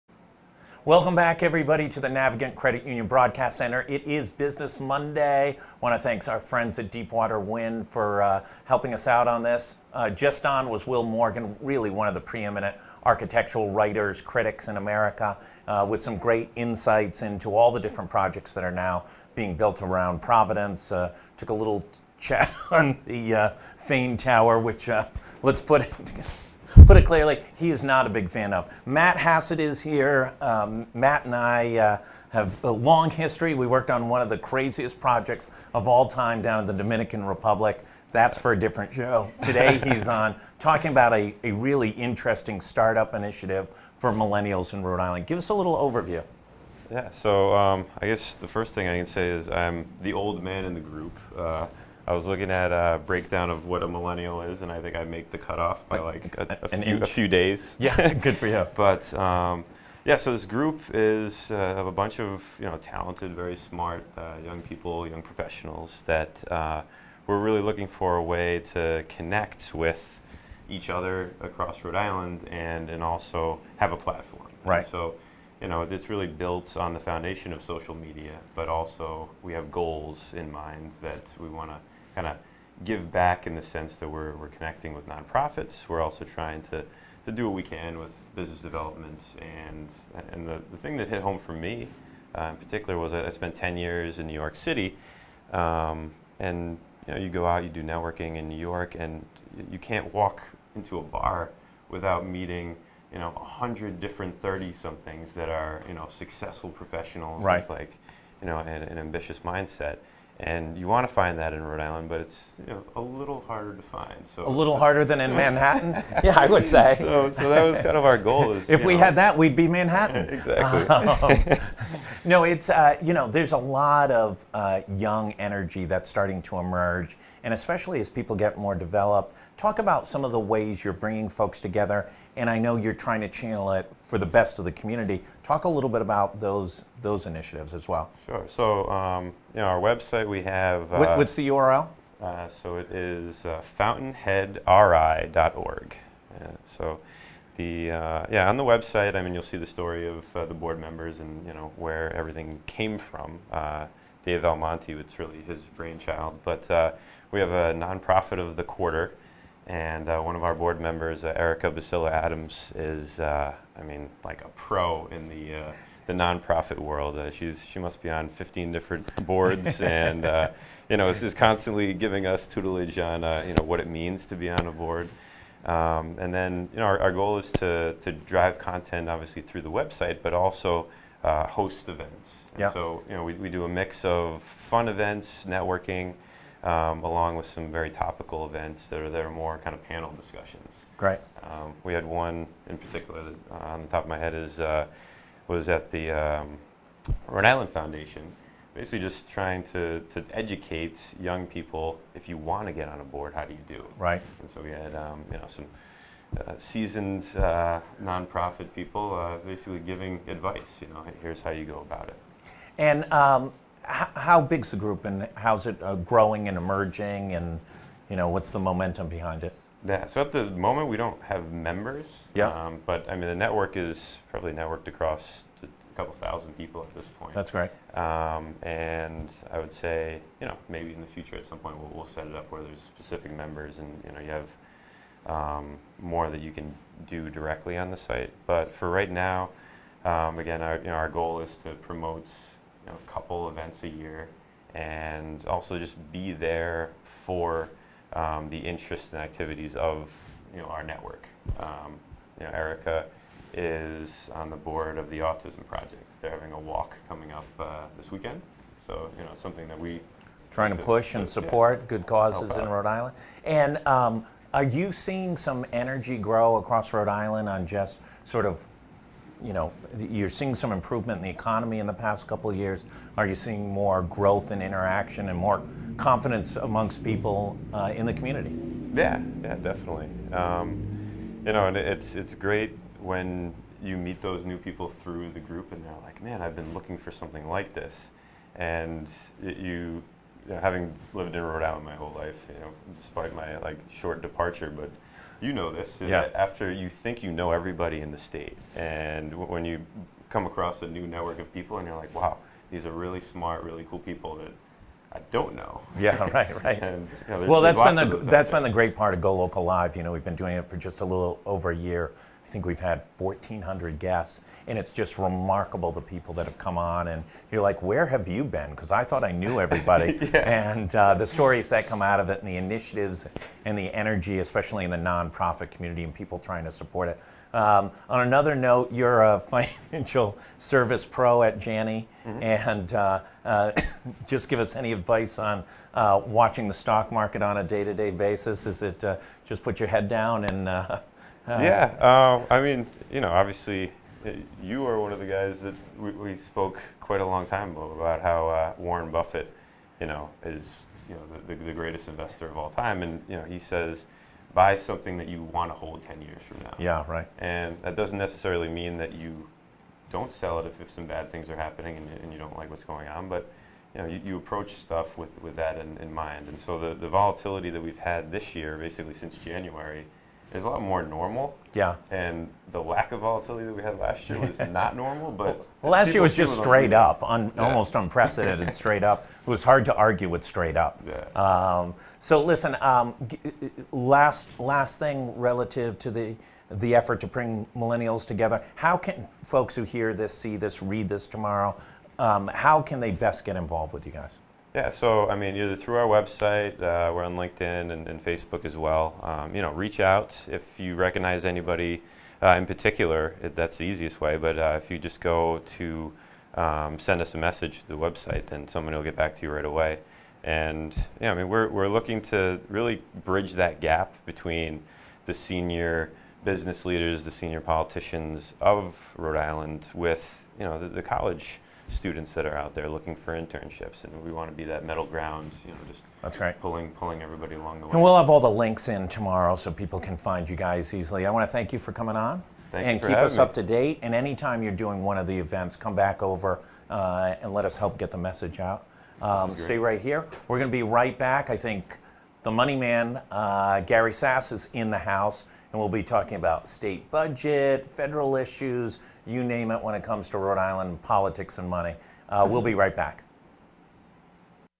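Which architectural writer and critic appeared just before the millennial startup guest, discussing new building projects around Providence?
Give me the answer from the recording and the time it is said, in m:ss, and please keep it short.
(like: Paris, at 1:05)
Will Morgan, at 0:10.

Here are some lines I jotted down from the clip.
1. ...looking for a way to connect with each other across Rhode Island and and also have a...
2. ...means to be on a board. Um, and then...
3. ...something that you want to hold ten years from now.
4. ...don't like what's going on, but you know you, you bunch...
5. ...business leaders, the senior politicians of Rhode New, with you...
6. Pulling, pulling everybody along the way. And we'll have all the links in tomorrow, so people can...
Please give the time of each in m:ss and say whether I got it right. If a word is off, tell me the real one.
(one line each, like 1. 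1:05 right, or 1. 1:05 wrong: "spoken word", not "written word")
1. 1:07 right
2. 2:53 right
3. 5:54 right
4. 6:02 wrong: "approach", not "bunch"
5. 6:56 wrong: "Island", not "New"
6. 7:06 right.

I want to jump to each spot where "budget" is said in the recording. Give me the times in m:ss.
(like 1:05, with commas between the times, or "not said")
7:27.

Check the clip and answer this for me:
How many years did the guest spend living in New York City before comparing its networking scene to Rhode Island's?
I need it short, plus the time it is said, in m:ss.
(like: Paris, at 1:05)
10, at 1:33.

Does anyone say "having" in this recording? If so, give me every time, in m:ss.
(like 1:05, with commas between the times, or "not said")
4:16, 4:50.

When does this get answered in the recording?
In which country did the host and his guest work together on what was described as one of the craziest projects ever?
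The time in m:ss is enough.
0:36.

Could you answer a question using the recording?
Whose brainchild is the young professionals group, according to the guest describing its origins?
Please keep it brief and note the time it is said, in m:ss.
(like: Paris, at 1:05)
Dave Almonte, at 2:34.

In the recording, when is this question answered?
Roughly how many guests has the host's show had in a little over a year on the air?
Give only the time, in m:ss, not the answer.
5:13.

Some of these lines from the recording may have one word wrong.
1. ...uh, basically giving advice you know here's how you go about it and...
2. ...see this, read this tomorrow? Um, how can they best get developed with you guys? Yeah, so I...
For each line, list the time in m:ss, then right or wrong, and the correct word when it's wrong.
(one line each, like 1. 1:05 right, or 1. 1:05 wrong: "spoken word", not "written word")
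1. 3:29 right
2. 6:30 wrong: "involved", not "developed".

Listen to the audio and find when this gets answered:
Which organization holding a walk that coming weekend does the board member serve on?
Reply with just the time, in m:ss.
4:15.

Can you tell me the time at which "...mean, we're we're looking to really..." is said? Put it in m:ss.
6:51.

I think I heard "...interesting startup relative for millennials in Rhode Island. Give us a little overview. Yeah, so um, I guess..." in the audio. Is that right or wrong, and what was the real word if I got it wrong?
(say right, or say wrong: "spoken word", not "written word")
wrong: "initiative", not "relative".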